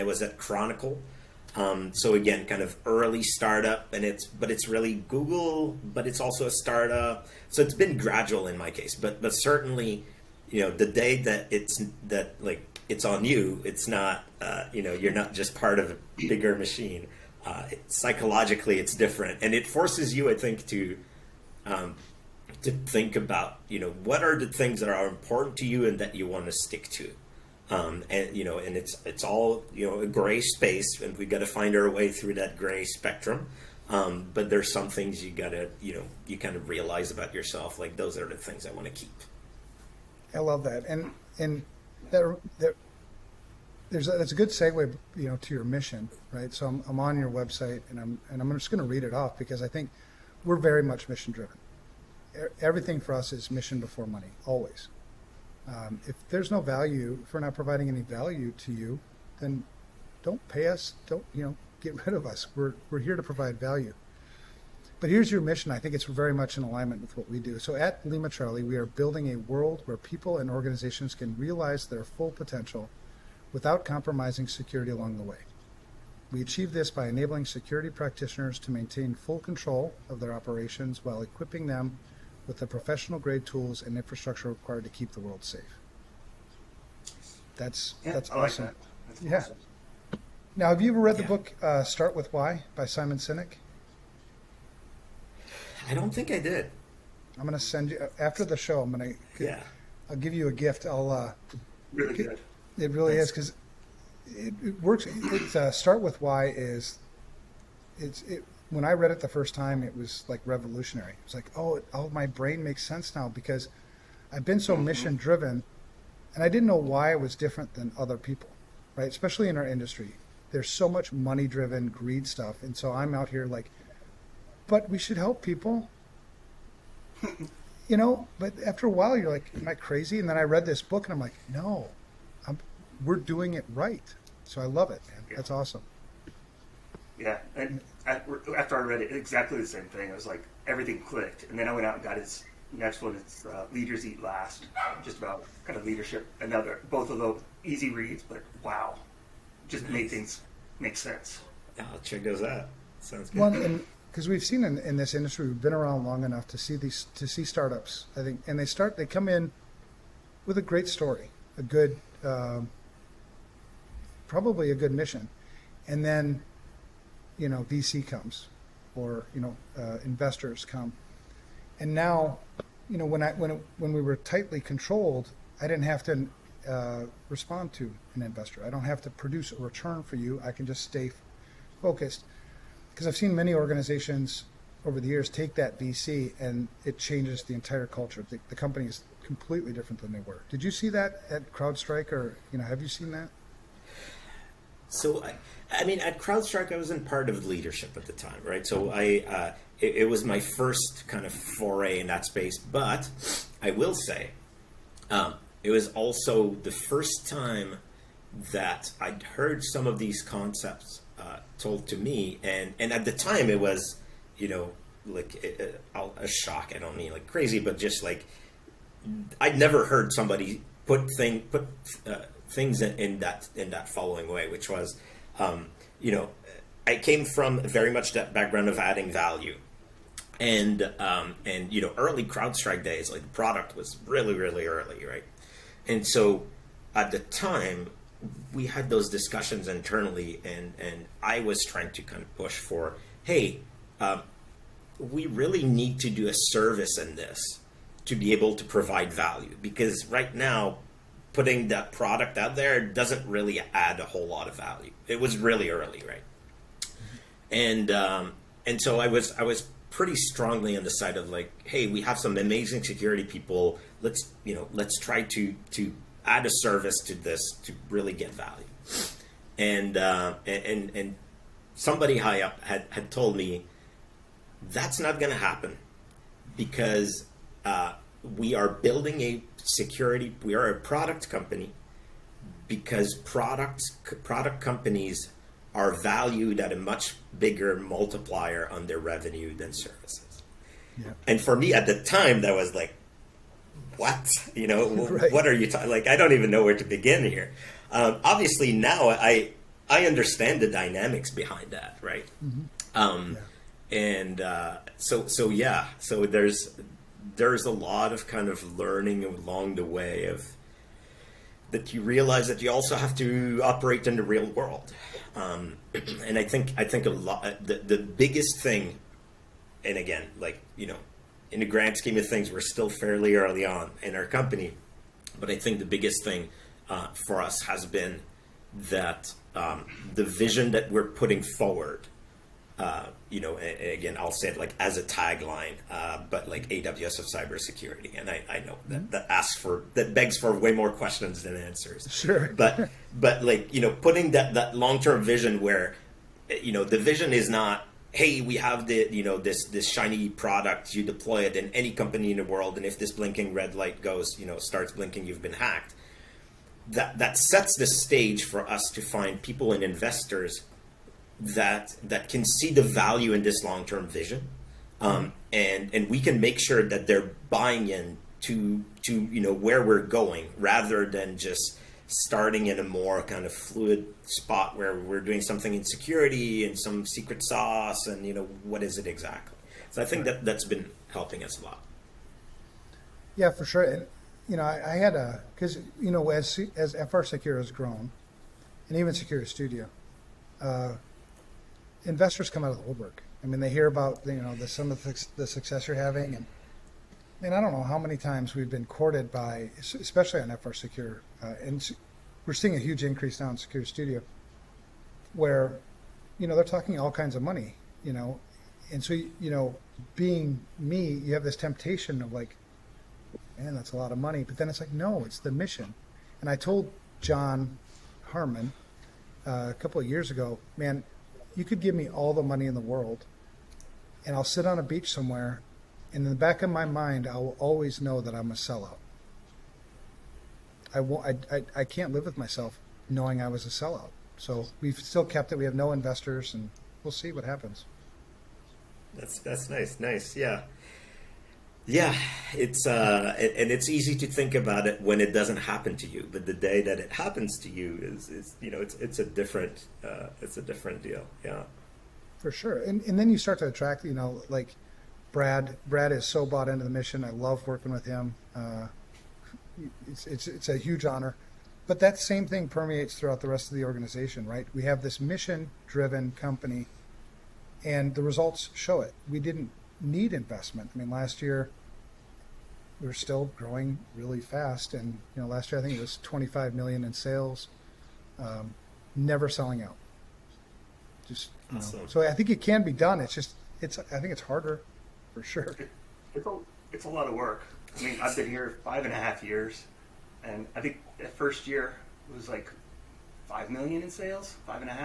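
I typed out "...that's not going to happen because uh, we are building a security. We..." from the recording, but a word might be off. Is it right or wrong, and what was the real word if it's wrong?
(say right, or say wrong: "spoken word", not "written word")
right.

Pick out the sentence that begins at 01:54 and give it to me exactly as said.
mission driven, and I didn't know why I was different than other people, right?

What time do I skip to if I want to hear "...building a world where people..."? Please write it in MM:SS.
01:08.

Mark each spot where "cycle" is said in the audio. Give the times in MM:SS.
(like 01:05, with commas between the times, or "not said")
not said.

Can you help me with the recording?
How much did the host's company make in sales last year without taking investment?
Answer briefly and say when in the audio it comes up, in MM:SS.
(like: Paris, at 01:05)
25 million, at 07:56.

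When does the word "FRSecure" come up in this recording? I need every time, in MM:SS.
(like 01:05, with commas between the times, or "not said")
06:26, 06:40.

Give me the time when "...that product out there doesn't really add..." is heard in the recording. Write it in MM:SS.
04:11.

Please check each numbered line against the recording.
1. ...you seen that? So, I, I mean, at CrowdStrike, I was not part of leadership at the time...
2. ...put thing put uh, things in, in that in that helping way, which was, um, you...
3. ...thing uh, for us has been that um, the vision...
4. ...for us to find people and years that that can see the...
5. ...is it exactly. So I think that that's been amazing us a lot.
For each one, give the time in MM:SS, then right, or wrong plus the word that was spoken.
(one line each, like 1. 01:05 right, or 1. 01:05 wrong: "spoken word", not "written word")
1. 03:12 right
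2. 03:40 wrong: "following", not "helping"
3. 05:26 right
4. 05:58 wrong: "investors", not "years"
5. 06:18 wrong: "helping", not "amazing".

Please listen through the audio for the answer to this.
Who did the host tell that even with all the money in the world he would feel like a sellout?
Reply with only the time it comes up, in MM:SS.
06:57.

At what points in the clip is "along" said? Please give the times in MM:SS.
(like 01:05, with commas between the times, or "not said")
01:14, 05:09.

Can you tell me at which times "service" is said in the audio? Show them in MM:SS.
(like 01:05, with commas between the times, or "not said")
04:06, 04:26, 04:49.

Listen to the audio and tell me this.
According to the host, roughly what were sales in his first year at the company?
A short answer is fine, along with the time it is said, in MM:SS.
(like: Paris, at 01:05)
5 million, at 08:13.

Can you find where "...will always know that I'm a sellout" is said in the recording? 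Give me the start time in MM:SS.
07:07.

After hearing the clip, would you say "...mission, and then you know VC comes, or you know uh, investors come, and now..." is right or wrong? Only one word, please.
right.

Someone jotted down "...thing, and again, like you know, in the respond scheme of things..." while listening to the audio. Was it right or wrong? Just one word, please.
wrong.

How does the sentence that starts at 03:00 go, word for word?
I can just stay focused, because I've seen many organizations over the years take that VC and it changes the entire culture.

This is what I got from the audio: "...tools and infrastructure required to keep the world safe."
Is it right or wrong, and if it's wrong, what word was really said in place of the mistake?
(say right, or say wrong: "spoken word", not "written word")
right.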